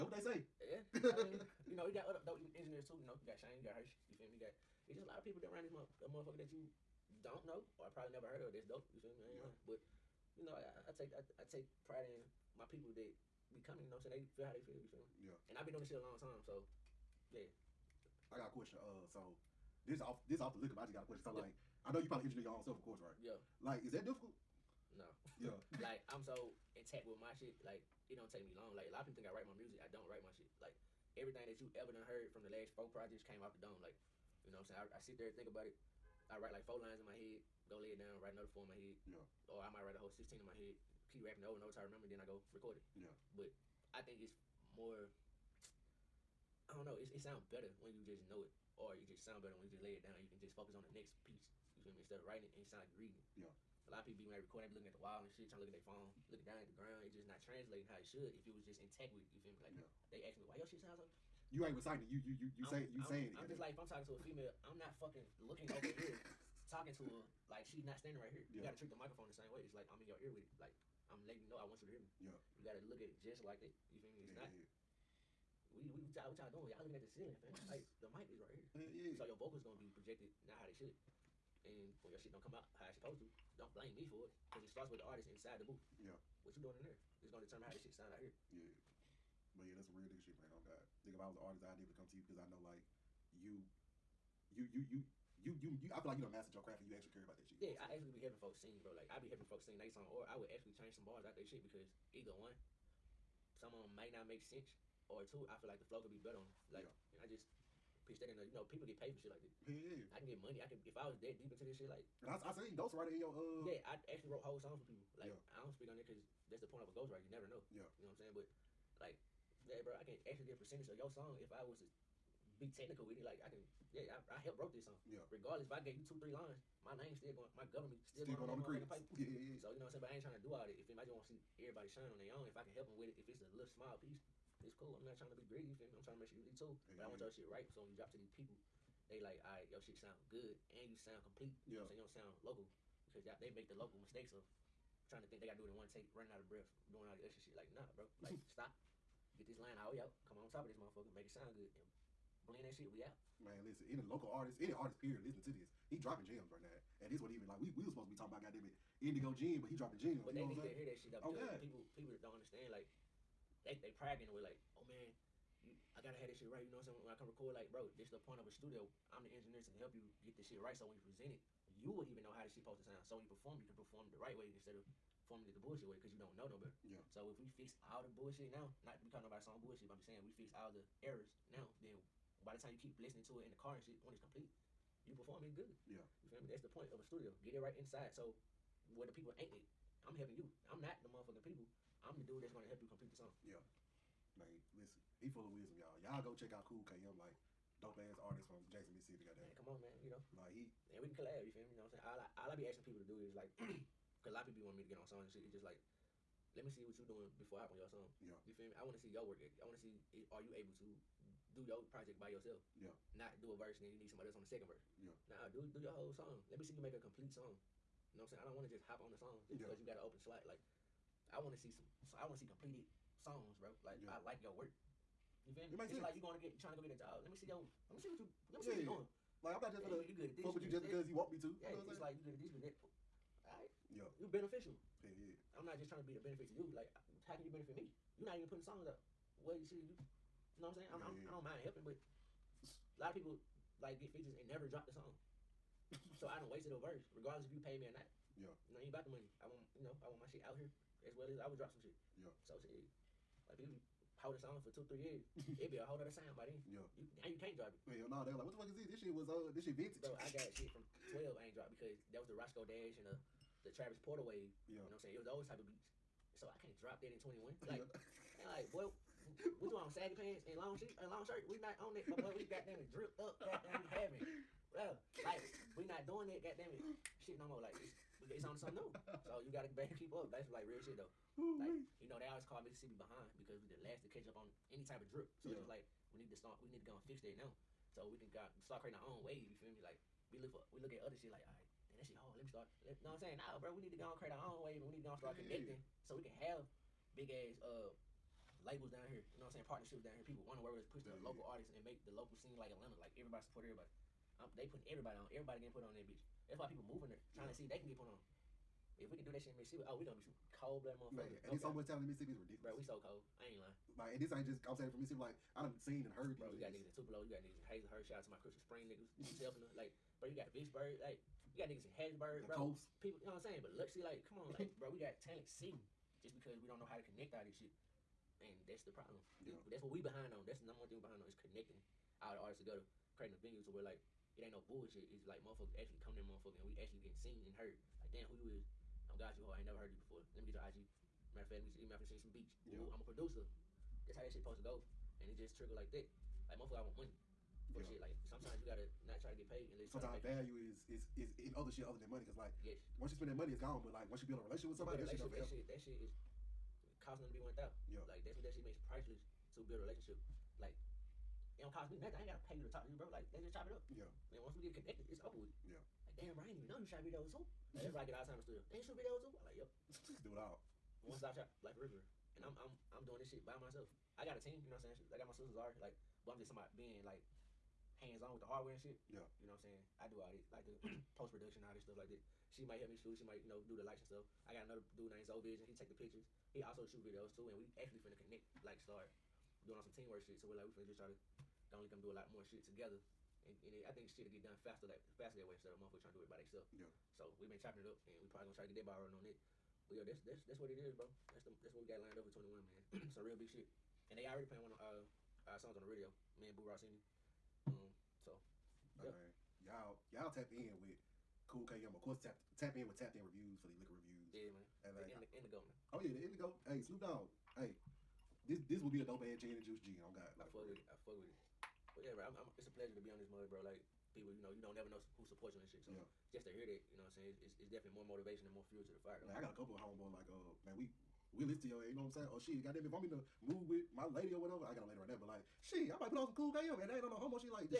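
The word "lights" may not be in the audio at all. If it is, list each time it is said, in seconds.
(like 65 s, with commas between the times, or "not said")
383 s.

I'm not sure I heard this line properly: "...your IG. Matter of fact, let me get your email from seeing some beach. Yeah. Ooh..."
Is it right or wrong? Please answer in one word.
right.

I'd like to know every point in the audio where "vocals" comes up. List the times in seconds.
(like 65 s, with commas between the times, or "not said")
79 s.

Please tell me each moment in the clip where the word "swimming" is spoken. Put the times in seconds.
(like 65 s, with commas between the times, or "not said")
not said.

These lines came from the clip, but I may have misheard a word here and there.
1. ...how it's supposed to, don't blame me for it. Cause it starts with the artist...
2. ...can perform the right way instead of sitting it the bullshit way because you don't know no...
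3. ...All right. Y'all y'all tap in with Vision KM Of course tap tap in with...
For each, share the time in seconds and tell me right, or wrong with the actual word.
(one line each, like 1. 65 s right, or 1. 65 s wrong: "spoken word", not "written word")
1. 82 s right
2. 173 s wrong: "performing", not "sitting"
3. 409 s wrong: "Cool", not "Vision".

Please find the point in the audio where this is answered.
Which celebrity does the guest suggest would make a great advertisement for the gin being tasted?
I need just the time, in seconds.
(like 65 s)
416 s.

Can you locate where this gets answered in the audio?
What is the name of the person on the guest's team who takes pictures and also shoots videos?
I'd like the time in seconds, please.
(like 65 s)
385 s.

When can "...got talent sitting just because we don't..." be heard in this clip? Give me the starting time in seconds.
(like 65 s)
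324 s.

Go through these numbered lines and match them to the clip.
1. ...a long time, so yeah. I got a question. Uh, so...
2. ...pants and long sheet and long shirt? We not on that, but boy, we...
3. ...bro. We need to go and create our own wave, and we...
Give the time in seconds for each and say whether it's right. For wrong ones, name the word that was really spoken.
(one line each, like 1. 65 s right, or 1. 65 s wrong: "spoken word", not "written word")
1. 15 s right
2. 270 s right
3. 293 s right.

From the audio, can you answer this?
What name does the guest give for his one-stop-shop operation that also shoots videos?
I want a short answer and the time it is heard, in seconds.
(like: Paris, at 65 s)
Black River, at 371 s.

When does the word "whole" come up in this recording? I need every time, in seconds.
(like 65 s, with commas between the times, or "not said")
39 s, 114 s, 215 s, 255 s.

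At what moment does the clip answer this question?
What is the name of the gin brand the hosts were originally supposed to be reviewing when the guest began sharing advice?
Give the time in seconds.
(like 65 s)
159 s.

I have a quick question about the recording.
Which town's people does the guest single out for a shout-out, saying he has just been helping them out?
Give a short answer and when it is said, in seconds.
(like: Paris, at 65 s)
Crystal Spring, at 318 s.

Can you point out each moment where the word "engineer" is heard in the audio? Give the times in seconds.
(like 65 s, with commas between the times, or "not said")
2 s, 22 s, 169 s.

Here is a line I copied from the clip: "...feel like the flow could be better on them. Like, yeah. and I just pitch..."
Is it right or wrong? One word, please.
right.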